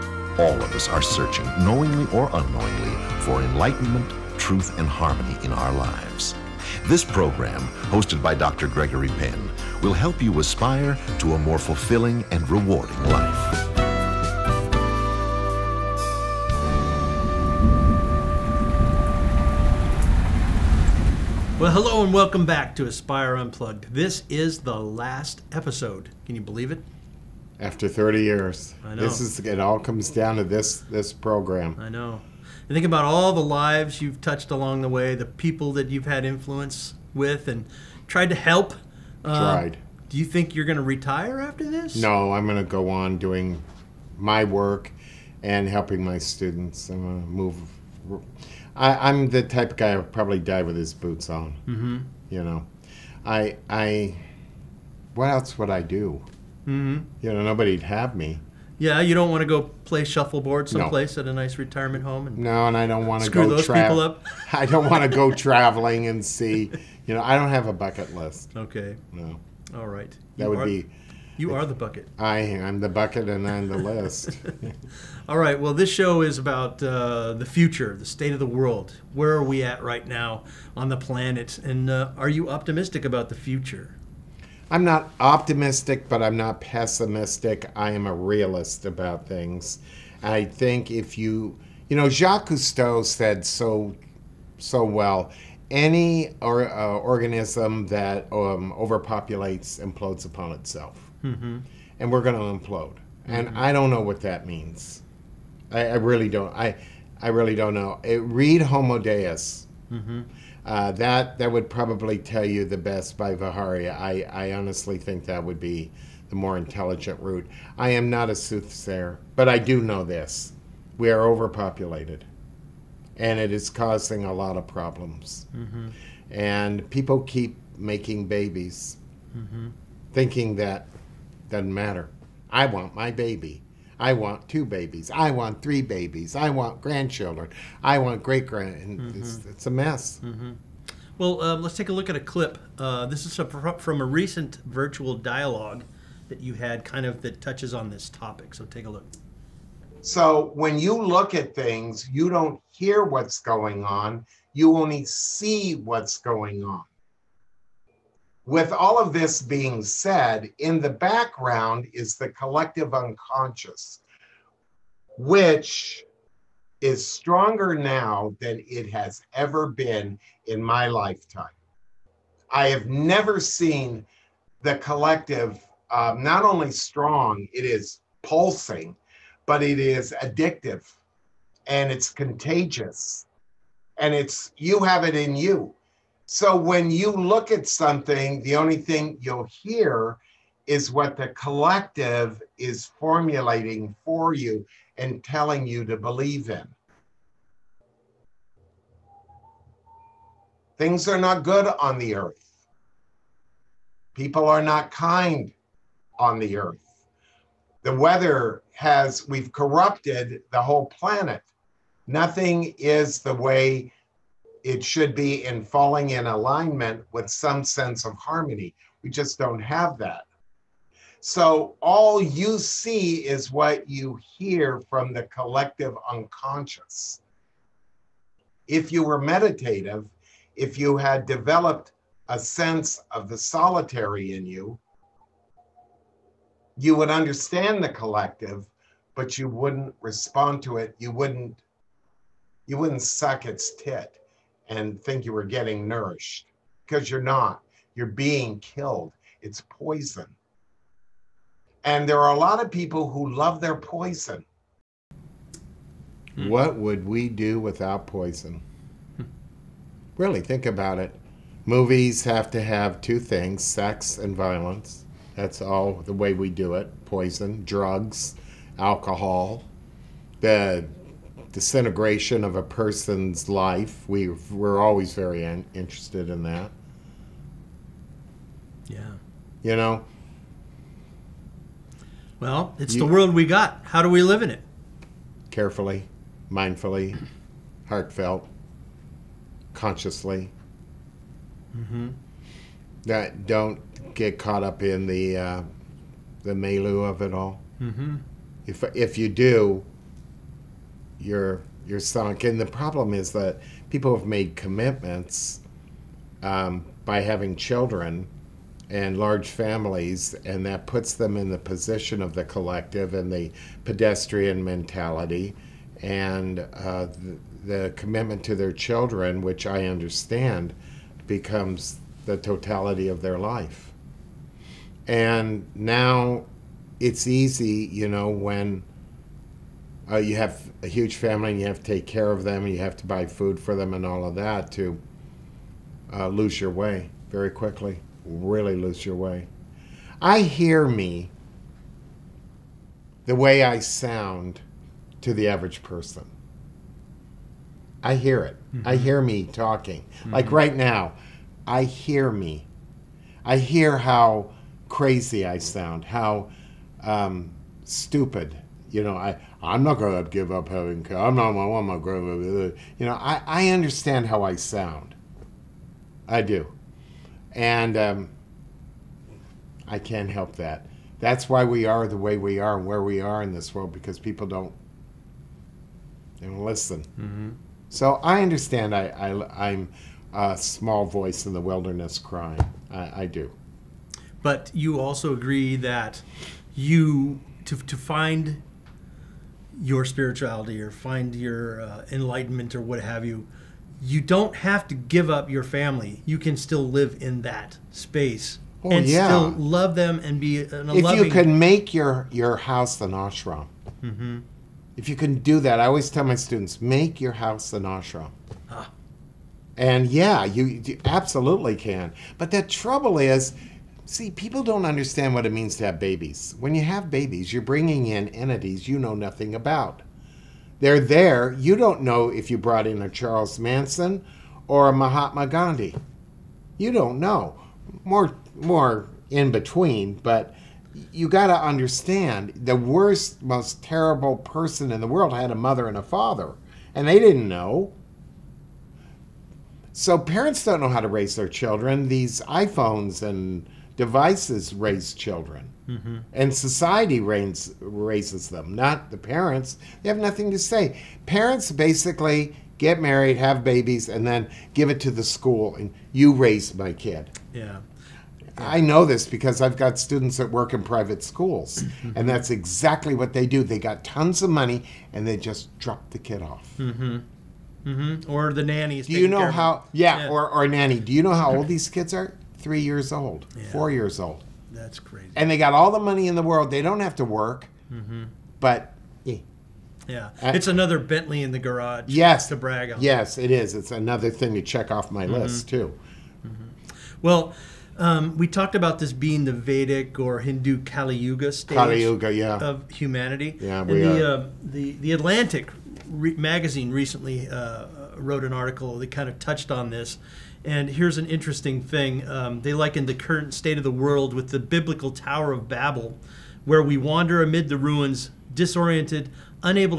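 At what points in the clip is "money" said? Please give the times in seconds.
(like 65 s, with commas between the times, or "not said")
464 s, 475 s.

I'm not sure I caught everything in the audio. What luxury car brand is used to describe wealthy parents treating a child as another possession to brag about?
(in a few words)
Bentley.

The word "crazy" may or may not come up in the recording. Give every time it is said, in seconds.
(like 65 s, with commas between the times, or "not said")
354 s, 474 s.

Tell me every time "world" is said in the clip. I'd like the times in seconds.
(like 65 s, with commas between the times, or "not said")
78 s, 283 s, 373 s, 435 s, 476 s, 503 s.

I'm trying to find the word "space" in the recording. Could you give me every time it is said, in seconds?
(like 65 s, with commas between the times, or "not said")
397 s.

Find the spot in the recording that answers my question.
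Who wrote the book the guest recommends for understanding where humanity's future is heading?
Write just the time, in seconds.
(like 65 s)
113 s.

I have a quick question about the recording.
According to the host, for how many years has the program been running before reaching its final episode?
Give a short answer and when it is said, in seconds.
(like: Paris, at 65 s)
30, at 27 s.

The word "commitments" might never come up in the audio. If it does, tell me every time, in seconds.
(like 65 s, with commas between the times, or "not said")
304 s, 317 s.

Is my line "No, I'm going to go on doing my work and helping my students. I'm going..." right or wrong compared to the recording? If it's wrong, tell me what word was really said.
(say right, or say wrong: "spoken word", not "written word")
right.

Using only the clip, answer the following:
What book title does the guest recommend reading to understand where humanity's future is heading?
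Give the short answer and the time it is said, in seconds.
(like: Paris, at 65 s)
Homo Deus, at 108 s.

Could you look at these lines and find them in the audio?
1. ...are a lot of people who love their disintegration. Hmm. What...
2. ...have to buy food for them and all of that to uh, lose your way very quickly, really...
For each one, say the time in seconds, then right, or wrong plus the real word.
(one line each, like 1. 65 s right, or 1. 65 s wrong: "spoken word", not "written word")
1. 252 s wrong: "poison", not "disintegration"
2. 332 s right.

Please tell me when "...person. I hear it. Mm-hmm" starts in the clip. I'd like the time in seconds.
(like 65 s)
345 s.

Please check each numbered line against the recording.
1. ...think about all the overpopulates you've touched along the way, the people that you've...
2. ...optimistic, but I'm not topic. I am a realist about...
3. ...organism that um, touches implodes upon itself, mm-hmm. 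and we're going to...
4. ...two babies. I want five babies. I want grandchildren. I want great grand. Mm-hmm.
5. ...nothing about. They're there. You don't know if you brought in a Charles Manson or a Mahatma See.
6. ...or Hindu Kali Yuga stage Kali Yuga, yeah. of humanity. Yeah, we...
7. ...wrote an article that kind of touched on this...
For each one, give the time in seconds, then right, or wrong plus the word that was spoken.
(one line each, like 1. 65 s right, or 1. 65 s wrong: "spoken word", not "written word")
1. 32 s wrong: "lives", not "overpopulates"
2. 85 s wrong: "pessimistic", not "topic"
3. 96 s wrong: "overpopulates", not "touches"
4. 134 s wrong: "three", not "five"
5. 419 s wrong: "Gandhi", not "See"
6. 490 s right
7. 498 s right.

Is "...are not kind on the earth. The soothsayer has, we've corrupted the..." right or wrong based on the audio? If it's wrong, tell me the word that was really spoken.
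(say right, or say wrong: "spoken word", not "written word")
wrong: "weather", not "soothsayer".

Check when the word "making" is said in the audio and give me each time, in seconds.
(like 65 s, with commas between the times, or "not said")
127 s.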